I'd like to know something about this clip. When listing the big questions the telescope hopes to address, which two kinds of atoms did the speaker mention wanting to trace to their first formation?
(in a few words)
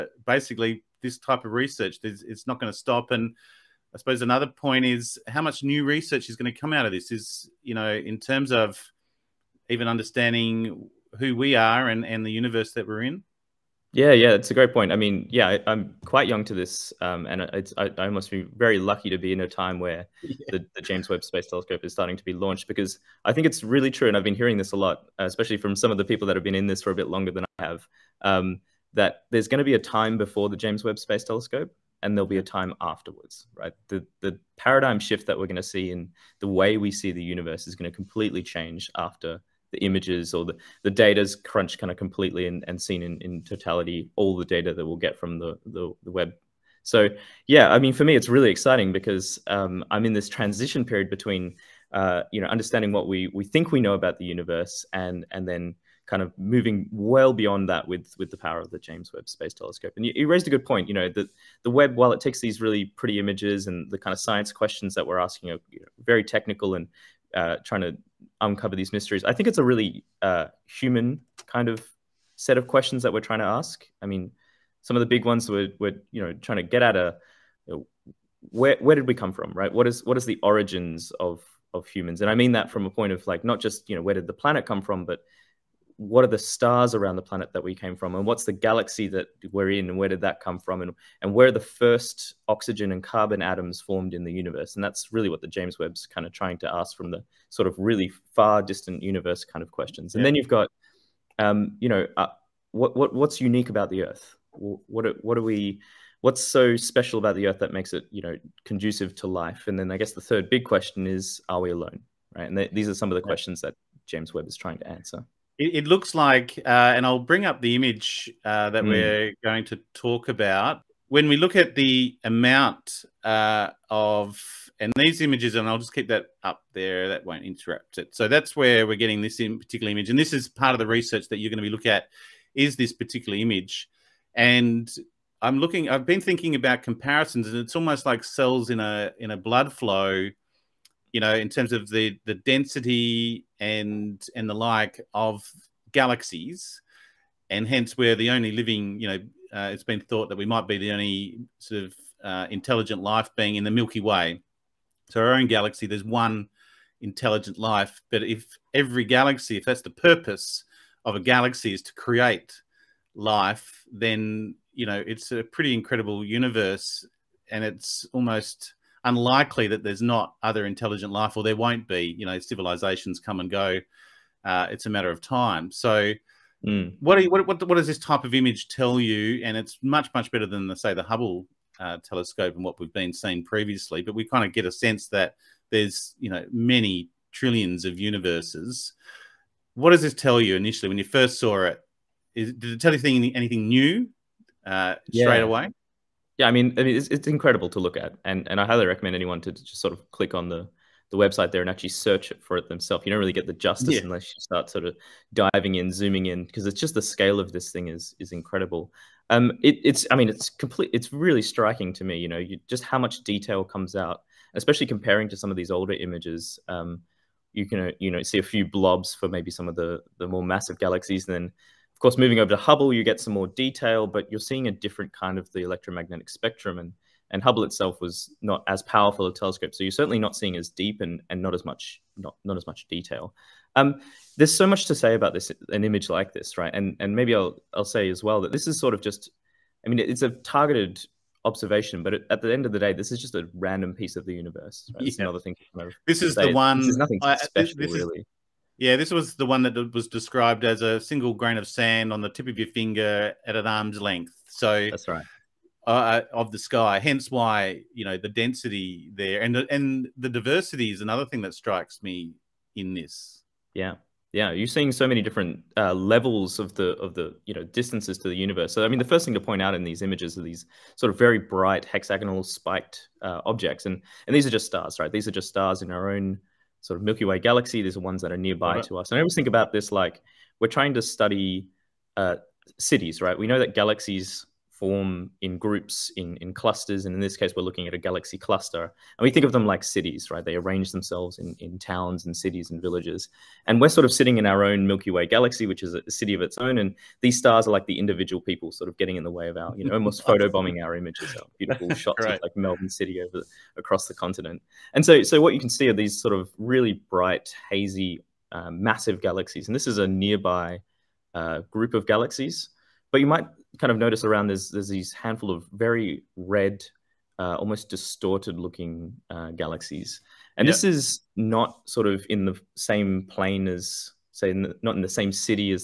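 Oxygen and carbon.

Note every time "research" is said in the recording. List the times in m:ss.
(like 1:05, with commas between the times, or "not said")
0:01, 0:05, 2:10.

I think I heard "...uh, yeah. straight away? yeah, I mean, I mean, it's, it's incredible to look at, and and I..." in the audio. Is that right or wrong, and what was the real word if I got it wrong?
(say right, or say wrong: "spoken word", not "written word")
right.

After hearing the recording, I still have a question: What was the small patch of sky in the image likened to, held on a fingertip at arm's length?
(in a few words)
A single grain of sand.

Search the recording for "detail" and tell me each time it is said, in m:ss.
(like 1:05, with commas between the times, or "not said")
3:33, 3:43, 3:52.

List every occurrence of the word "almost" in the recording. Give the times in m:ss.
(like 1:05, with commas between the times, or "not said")
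2:17, 2:48, 4:59, 5:17.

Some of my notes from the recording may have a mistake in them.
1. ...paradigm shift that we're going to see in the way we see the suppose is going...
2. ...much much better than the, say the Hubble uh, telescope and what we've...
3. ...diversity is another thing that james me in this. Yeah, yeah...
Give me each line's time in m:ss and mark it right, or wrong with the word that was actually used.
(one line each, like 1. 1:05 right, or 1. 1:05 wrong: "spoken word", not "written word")
1. 0:34 wrong: "universe", not "suppose"
2. 2:59 right
3. 4:20 wrong: "strikes", not "james".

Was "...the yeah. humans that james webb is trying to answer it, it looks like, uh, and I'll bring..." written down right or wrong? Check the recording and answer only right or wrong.
wrong.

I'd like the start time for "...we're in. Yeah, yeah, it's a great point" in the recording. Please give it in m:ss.
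0:12.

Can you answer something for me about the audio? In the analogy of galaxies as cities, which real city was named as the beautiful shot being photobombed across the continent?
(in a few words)
Melbourne.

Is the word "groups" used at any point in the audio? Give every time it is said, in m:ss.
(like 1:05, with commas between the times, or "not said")
4:45, 5:11.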